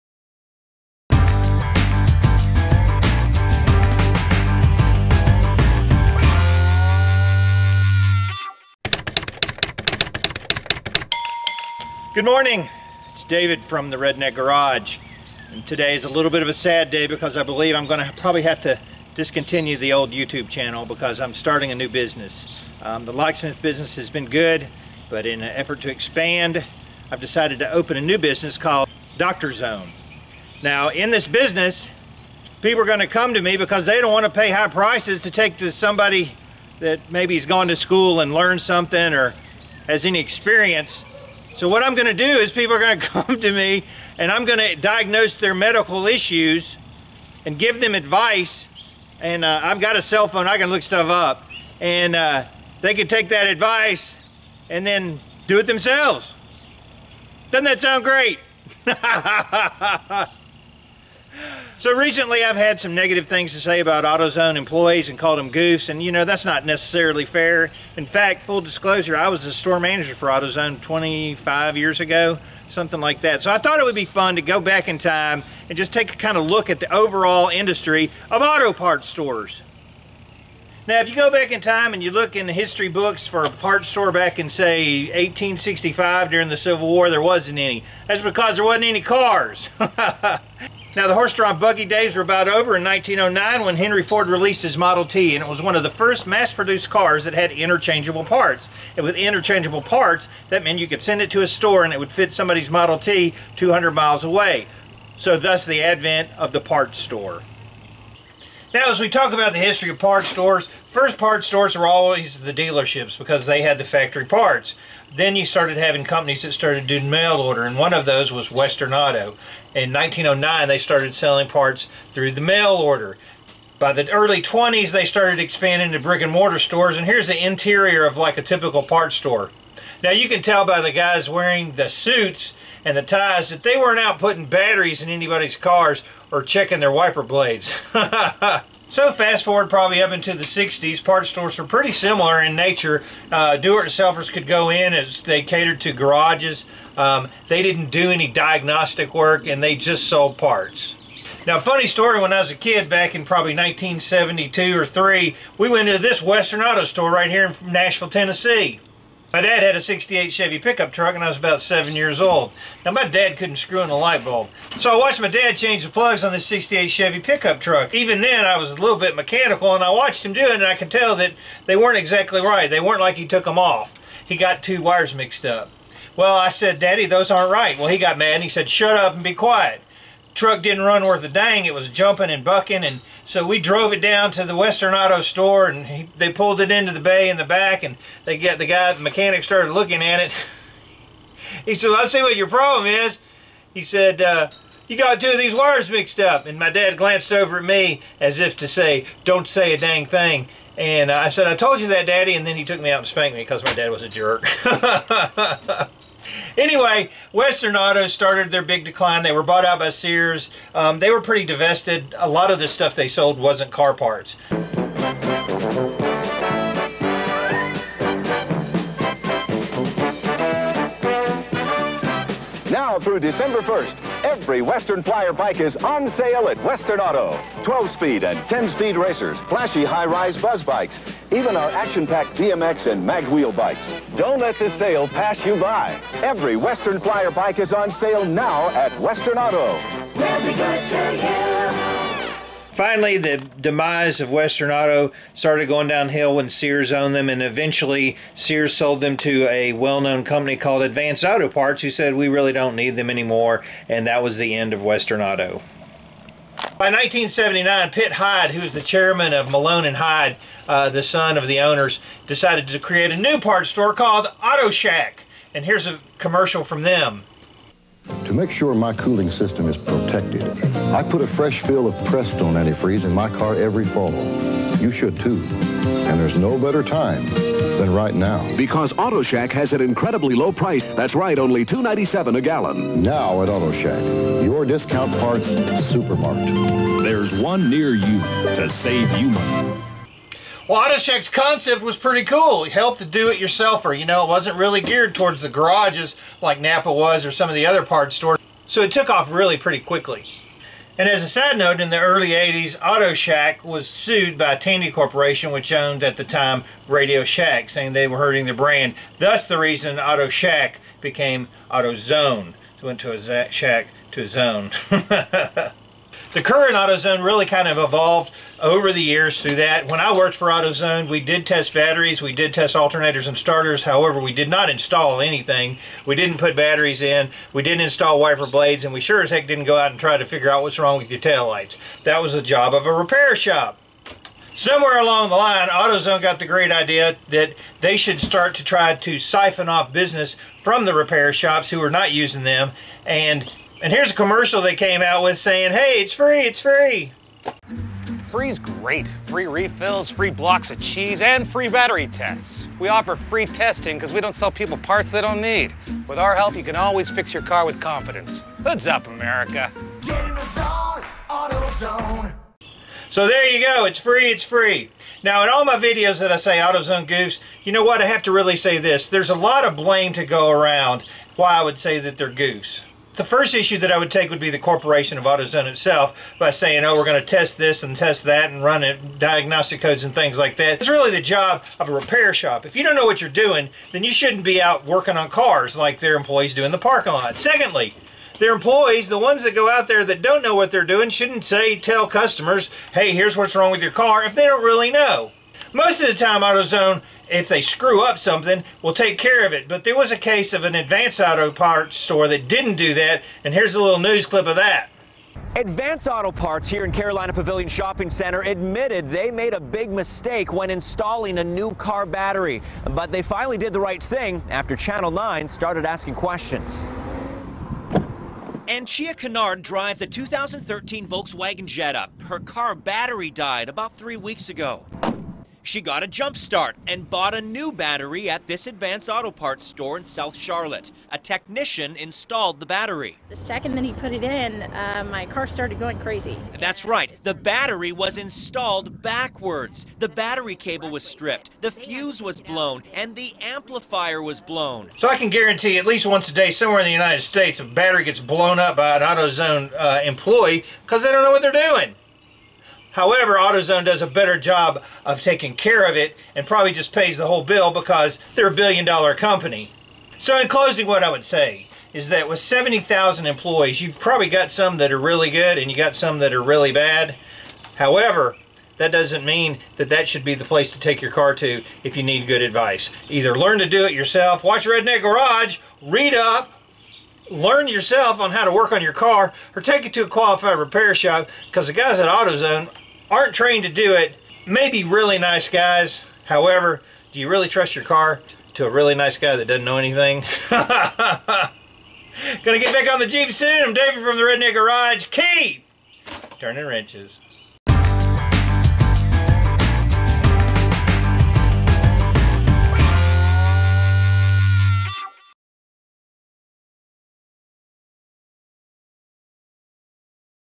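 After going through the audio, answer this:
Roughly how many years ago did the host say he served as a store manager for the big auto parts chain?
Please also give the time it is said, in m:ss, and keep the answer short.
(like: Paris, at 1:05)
25, at 1:10.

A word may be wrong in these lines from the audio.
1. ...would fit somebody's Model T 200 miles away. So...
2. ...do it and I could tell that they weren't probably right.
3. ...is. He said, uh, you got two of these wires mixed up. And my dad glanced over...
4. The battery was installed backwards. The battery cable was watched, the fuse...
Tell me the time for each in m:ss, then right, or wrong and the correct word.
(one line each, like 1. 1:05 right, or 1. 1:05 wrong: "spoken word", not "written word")
1. 1:41 right
2. 2:50 wrong: "exactly", not "probably"
3. 3:12 right
4. 7:17 wrong: "stripped", not "watched".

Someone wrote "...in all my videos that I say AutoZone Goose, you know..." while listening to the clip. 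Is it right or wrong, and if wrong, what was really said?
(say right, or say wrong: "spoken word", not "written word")
right.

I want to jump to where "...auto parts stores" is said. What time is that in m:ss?
1:18.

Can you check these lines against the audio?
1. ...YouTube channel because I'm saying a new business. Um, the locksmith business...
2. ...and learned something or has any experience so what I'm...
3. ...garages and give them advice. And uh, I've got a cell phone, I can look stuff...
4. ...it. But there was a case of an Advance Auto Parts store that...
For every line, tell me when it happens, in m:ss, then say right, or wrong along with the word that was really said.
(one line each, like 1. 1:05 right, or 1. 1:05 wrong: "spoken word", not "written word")
1. 0:20 wrong: "starting", not "saying"
2. 0:38 right
3. 0:46 wrong: "issues", not "garages"
4. 6:39 right.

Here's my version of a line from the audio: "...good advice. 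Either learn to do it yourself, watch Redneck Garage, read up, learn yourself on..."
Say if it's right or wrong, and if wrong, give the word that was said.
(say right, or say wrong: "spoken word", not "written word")
right.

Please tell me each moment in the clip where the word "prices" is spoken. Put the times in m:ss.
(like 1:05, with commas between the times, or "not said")
0:34, 4:40.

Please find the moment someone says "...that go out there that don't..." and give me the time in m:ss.
6:29.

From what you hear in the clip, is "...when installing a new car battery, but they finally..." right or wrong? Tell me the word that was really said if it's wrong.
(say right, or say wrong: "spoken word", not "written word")
right.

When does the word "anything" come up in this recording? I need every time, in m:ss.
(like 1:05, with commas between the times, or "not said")
5:25, 8:09.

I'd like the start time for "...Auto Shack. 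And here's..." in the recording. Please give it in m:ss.
4:24.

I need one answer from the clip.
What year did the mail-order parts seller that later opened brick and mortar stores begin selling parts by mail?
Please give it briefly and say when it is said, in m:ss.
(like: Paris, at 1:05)
1909, at 1:59.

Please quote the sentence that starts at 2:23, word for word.
Uh, Do-it-yourselfers could go in as they catered to garages.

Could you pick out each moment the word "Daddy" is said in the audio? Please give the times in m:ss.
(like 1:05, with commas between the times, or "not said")
2:56, 3:22.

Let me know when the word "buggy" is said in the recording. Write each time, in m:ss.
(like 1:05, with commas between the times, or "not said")
1:31.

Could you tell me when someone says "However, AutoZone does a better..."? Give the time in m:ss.
7:32.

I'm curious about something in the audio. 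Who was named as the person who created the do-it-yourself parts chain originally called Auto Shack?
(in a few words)
Pitt Hyde.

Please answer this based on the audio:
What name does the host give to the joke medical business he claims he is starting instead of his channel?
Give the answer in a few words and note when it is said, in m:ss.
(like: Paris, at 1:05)
Doctor Zone, at 0:29.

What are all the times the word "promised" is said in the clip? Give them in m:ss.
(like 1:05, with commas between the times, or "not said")
not said.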